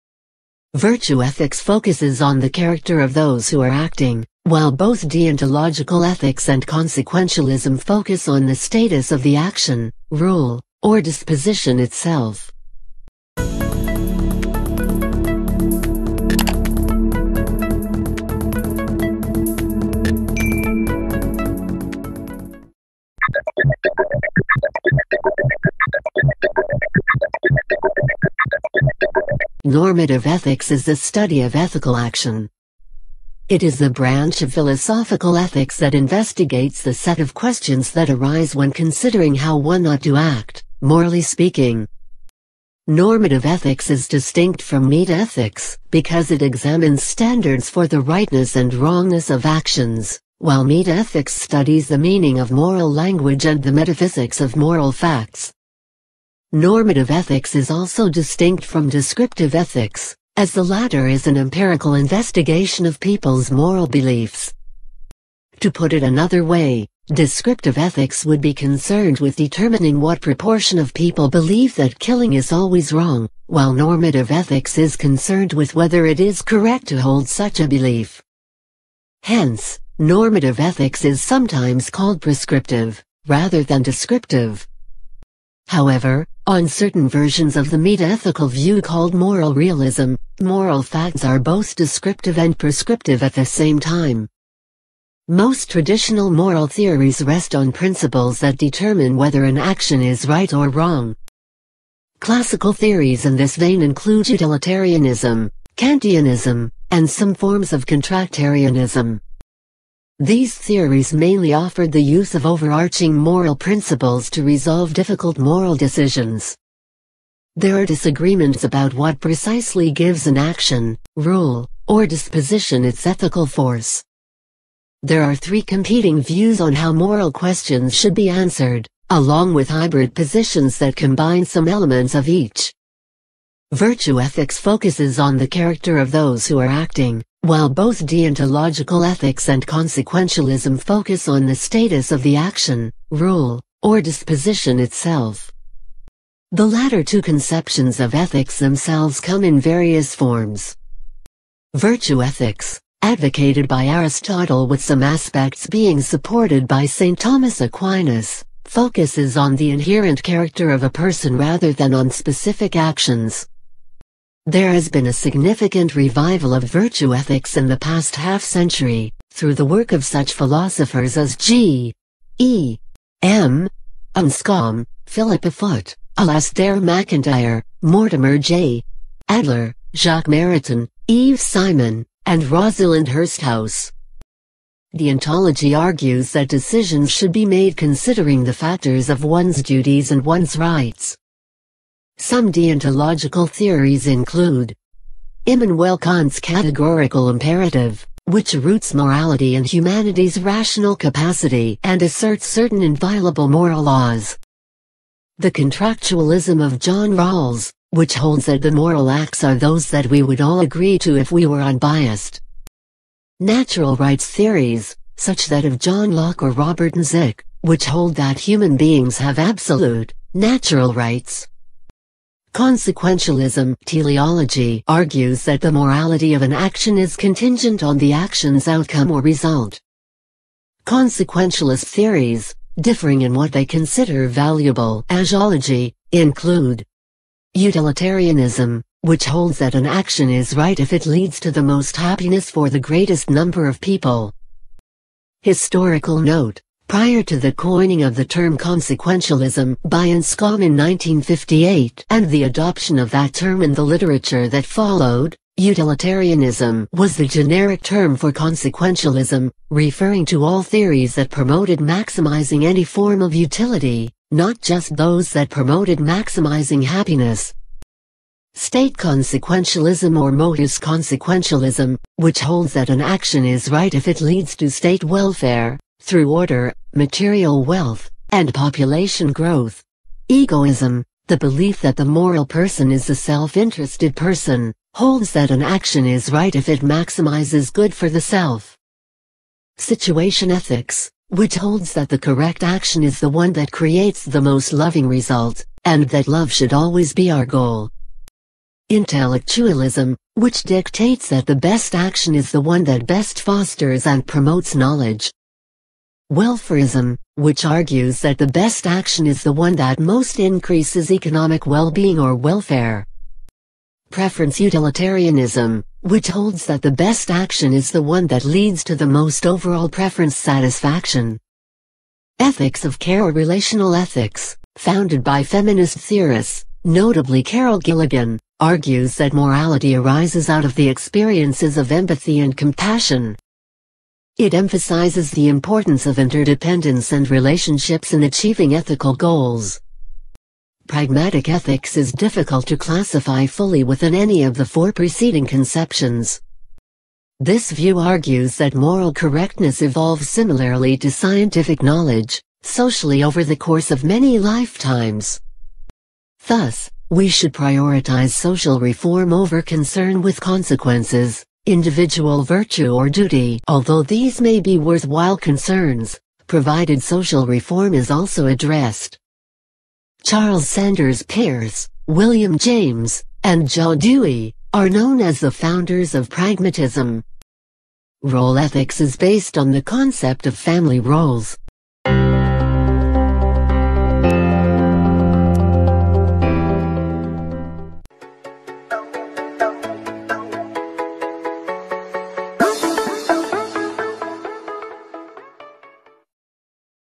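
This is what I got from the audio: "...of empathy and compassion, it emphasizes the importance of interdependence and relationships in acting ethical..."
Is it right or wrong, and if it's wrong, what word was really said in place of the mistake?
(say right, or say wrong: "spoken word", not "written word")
wrong: "achieving", not "acting".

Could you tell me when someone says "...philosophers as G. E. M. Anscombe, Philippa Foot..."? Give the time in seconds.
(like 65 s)
170 s.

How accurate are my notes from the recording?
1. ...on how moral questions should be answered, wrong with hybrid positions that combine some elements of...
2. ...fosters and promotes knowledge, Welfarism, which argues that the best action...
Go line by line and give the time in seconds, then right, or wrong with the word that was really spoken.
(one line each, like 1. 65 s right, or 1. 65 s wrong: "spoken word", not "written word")
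1. 126 s wrong: "along", not "wrong"
2. 303 s right.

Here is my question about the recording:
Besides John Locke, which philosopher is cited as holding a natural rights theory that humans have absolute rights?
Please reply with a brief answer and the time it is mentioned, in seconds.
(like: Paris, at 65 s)
Robert Nozick, at 216 s.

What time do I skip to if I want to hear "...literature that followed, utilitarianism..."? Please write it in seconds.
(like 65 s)
253 s.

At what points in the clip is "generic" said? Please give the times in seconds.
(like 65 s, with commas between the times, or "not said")
257 s.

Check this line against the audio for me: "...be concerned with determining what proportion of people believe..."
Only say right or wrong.
right.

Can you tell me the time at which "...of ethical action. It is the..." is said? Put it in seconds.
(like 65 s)
31 s.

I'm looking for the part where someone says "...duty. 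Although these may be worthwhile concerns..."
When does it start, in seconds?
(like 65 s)
363 s.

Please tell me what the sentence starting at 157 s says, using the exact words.
Thomas Aquinas, focuses on the inherent character of a person rather than on specific actions.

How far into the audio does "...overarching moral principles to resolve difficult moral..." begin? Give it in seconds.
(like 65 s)
112 s.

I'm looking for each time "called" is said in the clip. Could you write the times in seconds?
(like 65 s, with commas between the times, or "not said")
81 s, 88 s.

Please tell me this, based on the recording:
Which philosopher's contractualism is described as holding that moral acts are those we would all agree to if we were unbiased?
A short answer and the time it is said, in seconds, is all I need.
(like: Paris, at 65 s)
John Rawls, at 206 s.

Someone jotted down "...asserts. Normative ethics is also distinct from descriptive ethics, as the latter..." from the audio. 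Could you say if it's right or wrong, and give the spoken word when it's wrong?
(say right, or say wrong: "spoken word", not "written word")
wrong: "facts", not "asserts".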